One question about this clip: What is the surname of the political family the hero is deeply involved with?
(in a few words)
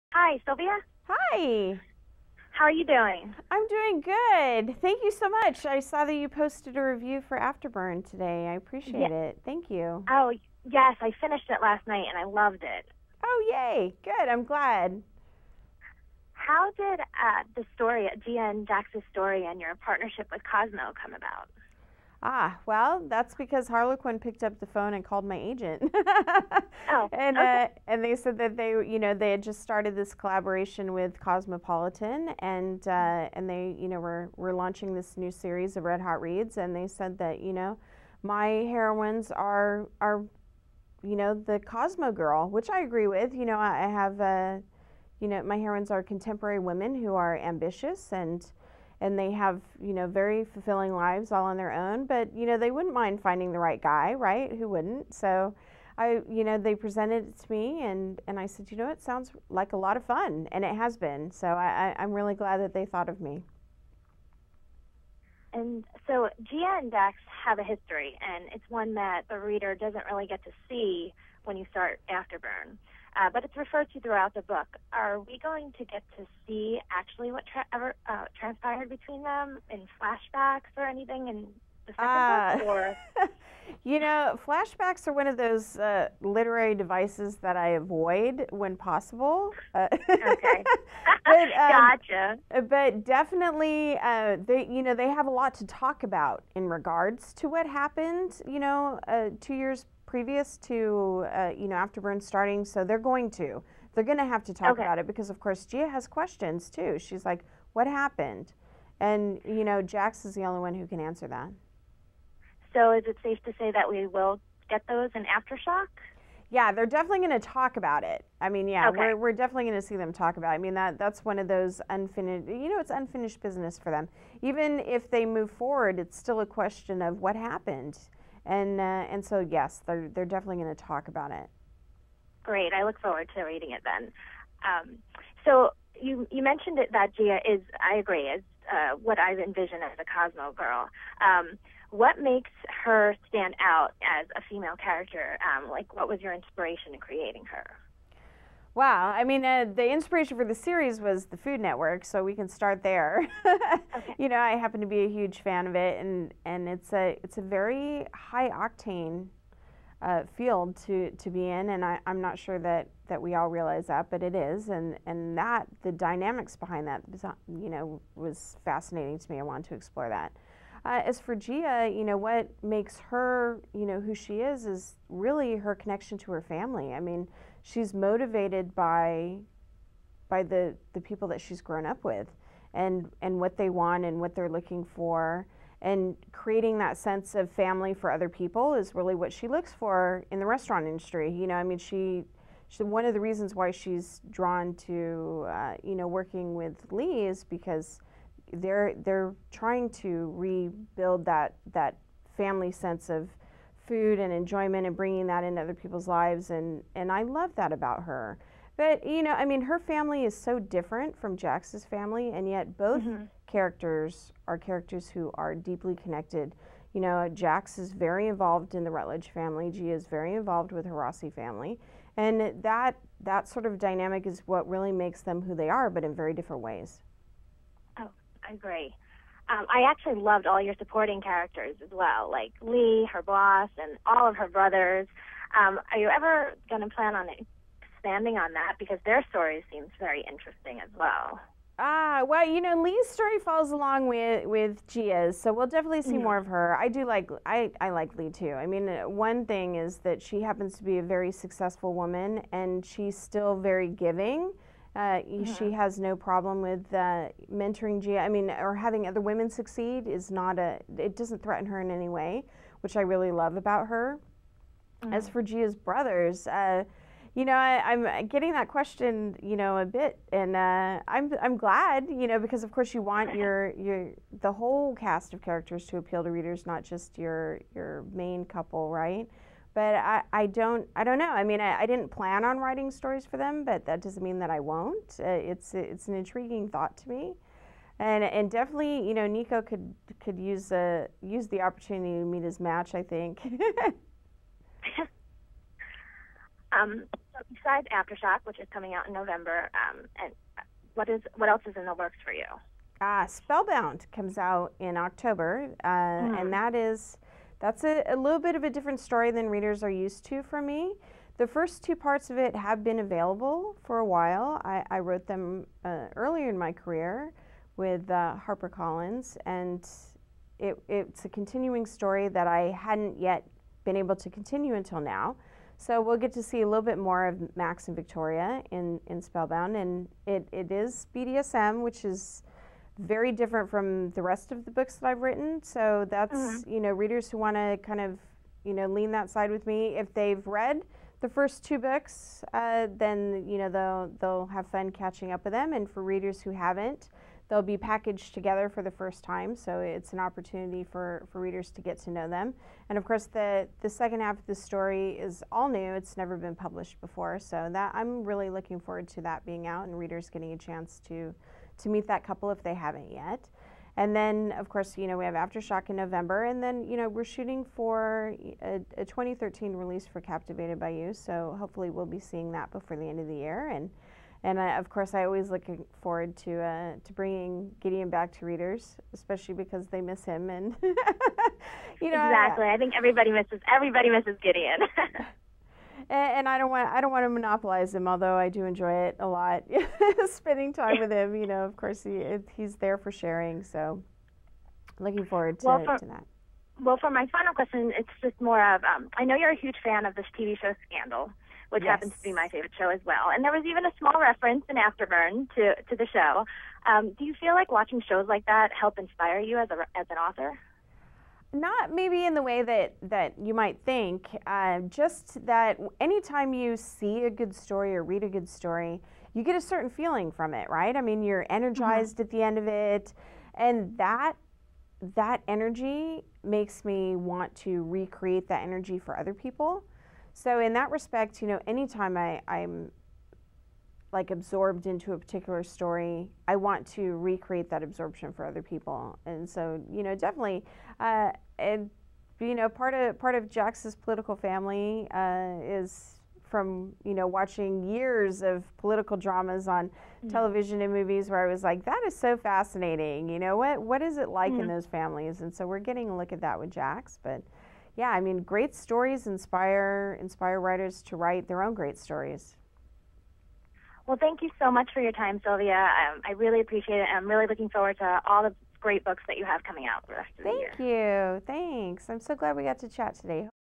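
Rutledge.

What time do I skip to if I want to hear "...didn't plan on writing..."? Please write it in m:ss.
4:41.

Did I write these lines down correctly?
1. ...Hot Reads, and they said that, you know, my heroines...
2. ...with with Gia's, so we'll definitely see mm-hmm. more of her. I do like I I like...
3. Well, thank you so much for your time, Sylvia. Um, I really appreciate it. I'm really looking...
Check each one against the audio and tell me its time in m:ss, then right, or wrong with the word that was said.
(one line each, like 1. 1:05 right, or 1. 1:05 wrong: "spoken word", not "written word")
1. 0:35 right
2. 4:04 right
3. 7:44 right.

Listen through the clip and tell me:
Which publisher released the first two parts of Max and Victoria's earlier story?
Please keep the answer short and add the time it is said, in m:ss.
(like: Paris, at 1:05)
HarperCollins, at 5:18.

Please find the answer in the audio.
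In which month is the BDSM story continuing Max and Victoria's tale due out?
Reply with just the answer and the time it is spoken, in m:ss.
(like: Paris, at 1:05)
October, at 5:04.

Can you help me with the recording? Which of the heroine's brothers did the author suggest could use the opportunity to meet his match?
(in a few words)
Nico.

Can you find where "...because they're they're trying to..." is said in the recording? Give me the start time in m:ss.
3:17.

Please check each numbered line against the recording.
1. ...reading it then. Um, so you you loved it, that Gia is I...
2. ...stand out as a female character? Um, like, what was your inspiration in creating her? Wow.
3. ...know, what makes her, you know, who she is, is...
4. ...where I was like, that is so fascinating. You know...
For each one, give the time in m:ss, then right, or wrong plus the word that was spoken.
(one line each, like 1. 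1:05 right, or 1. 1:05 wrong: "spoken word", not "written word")
1. 2:13 wrong: "mentioned", not "loved"
2. 2:23 right
3. 2:52 right
4. 7:31 right.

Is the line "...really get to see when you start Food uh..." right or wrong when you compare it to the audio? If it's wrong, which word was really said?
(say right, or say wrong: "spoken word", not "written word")
wrong: "Afterburn", not "Food".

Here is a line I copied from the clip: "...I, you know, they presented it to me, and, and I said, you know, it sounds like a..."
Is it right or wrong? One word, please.
right.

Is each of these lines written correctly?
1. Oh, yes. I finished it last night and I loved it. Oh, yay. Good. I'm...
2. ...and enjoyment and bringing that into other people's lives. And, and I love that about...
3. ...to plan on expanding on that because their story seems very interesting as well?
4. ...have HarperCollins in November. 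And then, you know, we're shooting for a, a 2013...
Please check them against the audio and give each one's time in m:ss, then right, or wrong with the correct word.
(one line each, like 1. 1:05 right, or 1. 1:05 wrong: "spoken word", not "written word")
1. 0:10 right
2. 3:24 right
3. 3:56 right
4. 6:05 wrong: "Aftershock", not "HarperCollins".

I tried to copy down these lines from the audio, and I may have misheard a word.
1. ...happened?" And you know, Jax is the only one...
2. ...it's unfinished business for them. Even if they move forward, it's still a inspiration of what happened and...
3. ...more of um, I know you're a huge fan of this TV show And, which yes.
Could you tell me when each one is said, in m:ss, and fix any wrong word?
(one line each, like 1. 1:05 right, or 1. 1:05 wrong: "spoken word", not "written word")
1. 1:47 right
2. 2:02 wrong: "question", not "inspiration"
3. 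6:38 wrong: "Scandal", not "And".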